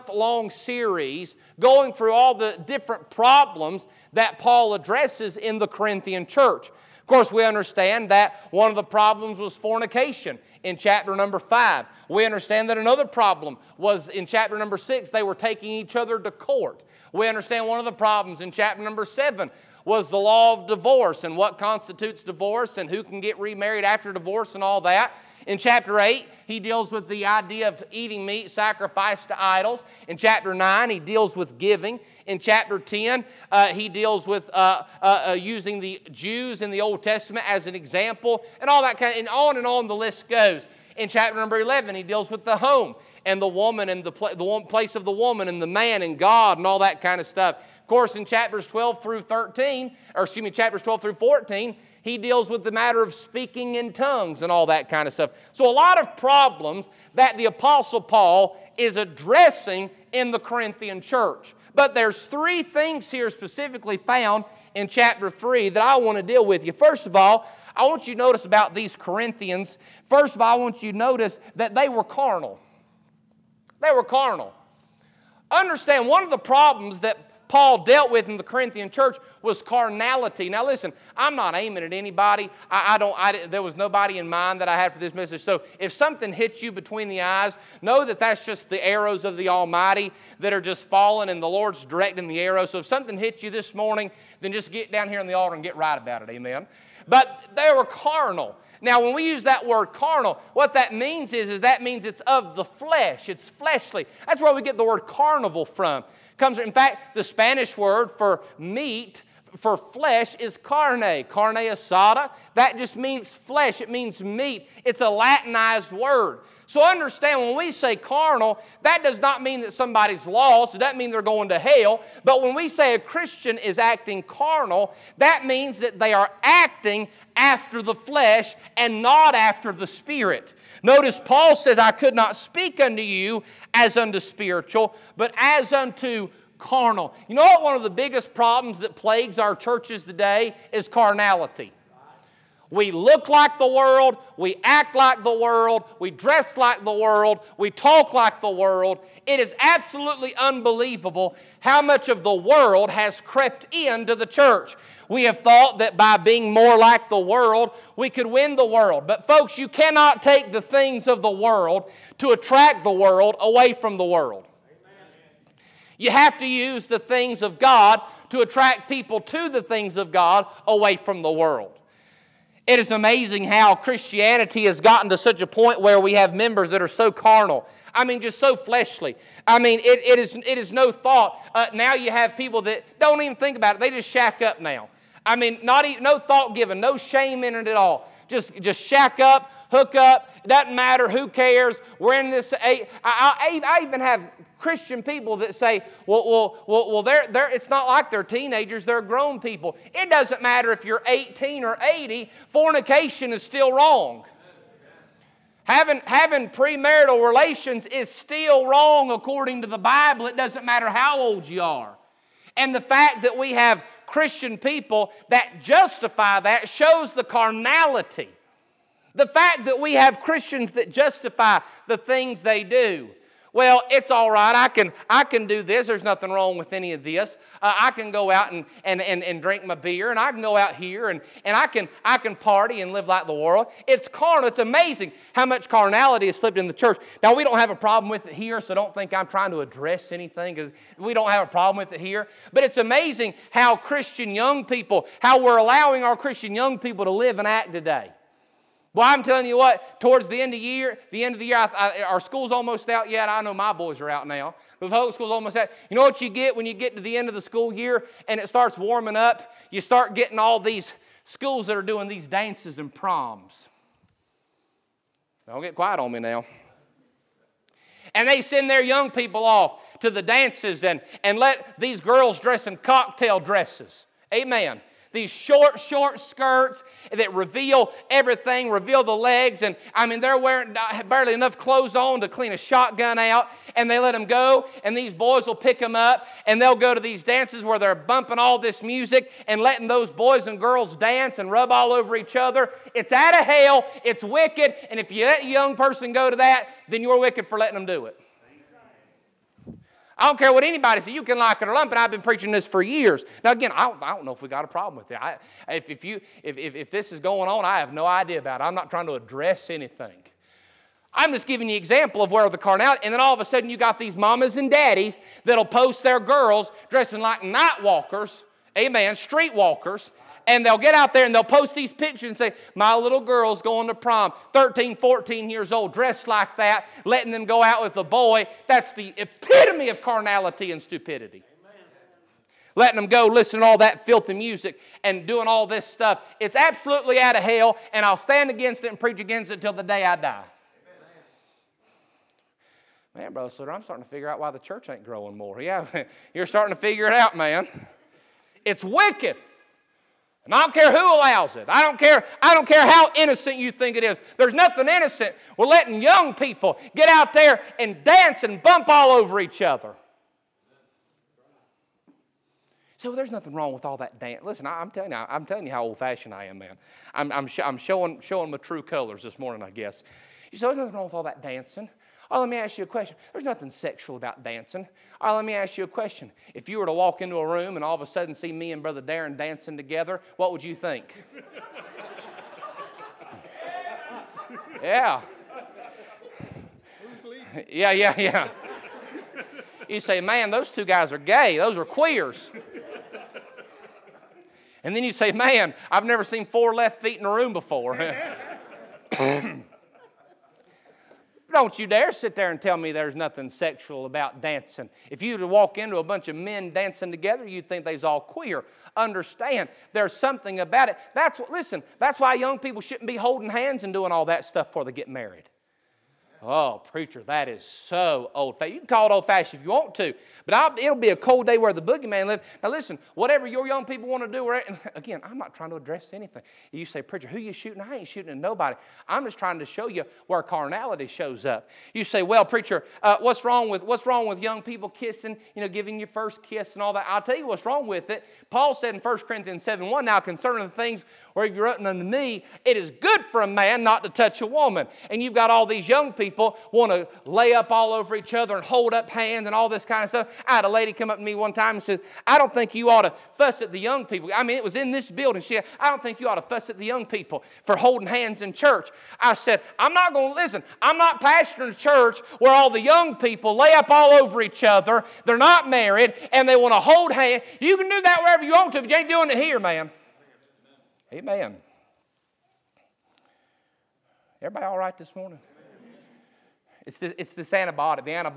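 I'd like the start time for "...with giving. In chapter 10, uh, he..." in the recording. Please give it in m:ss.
0:31.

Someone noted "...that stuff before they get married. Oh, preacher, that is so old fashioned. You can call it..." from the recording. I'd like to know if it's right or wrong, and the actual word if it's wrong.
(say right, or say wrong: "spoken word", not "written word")
right.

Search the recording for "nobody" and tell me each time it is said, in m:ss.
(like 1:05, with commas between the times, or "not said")
1:23, 7:08.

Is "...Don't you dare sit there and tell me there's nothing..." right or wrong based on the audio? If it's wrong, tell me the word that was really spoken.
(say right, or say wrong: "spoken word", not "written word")
right.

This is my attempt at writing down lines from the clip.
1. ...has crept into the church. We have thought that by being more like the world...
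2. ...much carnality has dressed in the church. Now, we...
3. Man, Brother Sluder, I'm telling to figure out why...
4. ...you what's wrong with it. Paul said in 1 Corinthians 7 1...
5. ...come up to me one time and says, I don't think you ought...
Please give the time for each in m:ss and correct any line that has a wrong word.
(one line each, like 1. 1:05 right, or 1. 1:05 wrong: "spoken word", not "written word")
1. 2:32 right
2. 3:55 wrong: "slipped", not "dressed"
3. 5:43 wrong: "starting", not "telling"
4. 7:17 right
5. 7:30 right.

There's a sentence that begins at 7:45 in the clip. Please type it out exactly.
They're not married and they want to hold hands.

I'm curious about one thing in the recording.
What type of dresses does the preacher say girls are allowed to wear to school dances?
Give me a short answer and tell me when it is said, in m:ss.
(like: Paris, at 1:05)
cocktail dresses, at 4:32.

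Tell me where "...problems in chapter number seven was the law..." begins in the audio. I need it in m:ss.
0:17.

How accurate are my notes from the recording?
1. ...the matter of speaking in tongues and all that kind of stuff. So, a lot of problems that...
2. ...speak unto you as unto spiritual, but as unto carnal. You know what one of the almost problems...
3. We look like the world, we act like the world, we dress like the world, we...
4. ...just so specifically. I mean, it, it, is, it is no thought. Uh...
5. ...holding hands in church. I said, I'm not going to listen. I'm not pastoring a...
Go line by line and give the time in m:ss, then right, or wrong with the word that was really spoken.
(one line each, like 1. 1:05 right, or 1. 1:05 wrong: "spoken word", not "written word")
1. 0:52 right
2. 2:12 wrong: "biggest", not "almost"
3. 2:22 right
4. 2:58 wrong: "fleshly", not "specifically"
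5. 7:37 right.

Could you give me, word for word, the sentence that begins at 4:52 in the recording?
It's out of hell, it's wicked.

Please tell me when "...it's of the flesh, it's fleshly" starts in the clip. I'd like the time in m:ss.
1:42.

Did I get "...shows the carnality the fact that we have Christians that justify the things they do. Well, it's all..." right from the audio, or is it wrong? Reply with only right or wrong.
right.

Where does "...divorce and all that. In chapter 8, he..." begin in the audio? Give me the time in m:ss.
0:24.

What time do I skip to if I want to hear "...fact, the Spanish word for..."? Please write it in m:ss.
1:46.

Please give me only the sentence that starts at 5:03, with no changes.
Now, again, I don't, I don't know if we got a problem with it.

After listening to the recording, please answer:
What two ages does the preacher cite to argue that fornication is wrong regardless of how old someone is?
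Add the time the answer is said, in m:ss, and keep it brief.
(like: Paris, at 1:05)
18 or 80, at 3:21.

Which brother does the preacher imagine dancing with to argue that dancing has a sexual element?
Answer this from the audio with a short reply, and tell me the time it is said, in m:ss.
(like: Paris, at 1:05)
Brother Darren, at 6:18.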